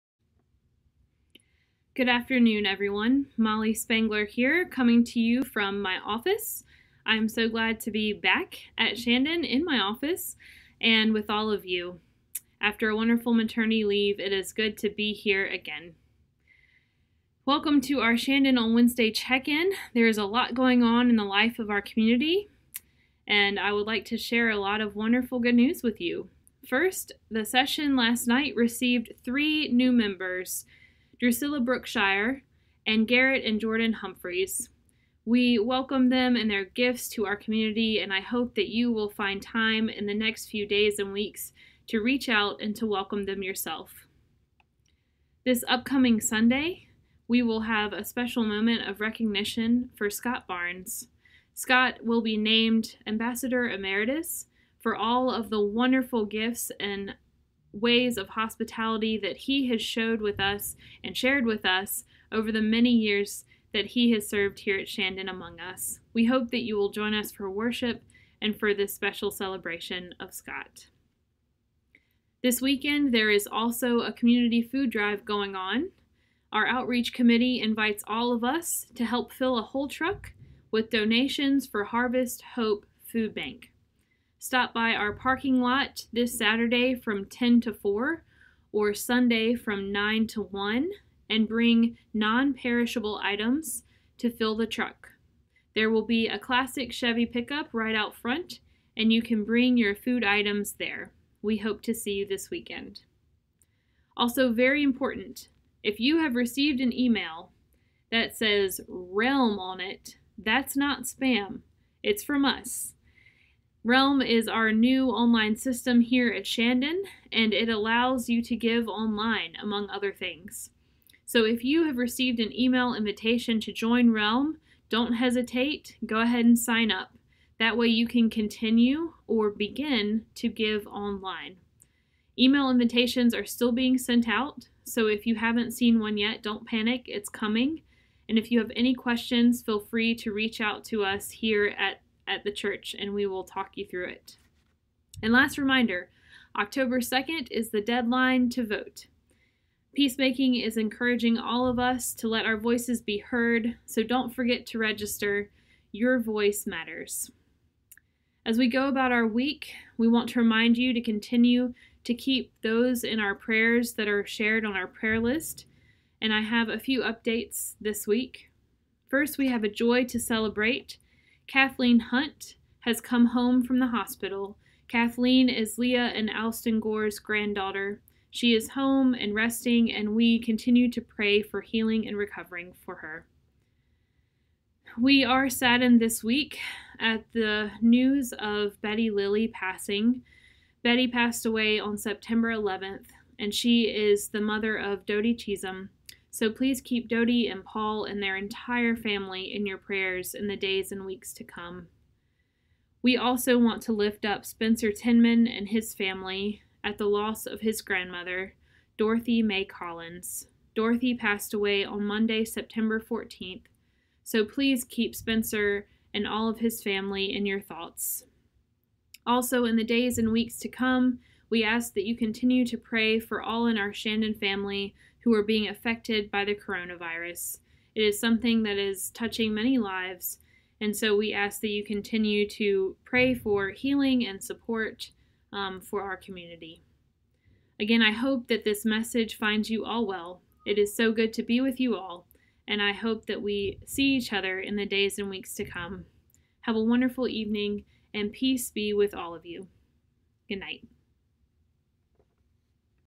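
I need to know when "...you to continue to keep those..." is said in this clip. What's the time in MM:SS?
02:40.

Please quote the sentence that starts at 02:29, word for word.
Peacemaking is encouraging all of us to let our voices be heard, so don't forget to register.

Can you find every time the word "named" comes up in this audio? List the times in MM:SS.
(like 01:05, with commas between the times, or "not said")
00:52.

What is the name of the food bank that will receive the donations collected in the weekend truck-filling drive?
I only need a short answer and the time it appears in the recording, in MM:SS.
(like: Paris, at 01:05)
Harvest Hope Food Bank, at 01:21.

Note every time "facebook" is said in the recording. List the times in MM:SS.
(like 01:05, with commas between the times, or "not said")
not said.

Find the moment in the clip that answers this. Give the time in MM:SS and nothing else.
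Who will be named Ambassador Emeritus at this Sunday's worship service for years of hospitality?
00:50.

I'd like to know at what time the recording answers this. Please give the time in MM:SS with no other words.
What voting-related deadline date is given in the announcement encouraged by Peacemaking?
02:26.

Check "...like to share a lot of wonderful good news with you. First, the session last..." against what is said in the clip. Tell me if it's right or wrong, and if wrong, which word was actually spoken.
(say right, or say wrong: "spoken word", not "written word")
right.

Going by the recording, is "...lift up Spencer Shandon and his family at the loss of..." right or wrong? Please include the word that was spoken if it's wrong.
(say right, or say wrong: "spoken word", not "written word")
wrong: "Tinman", not "Shandon".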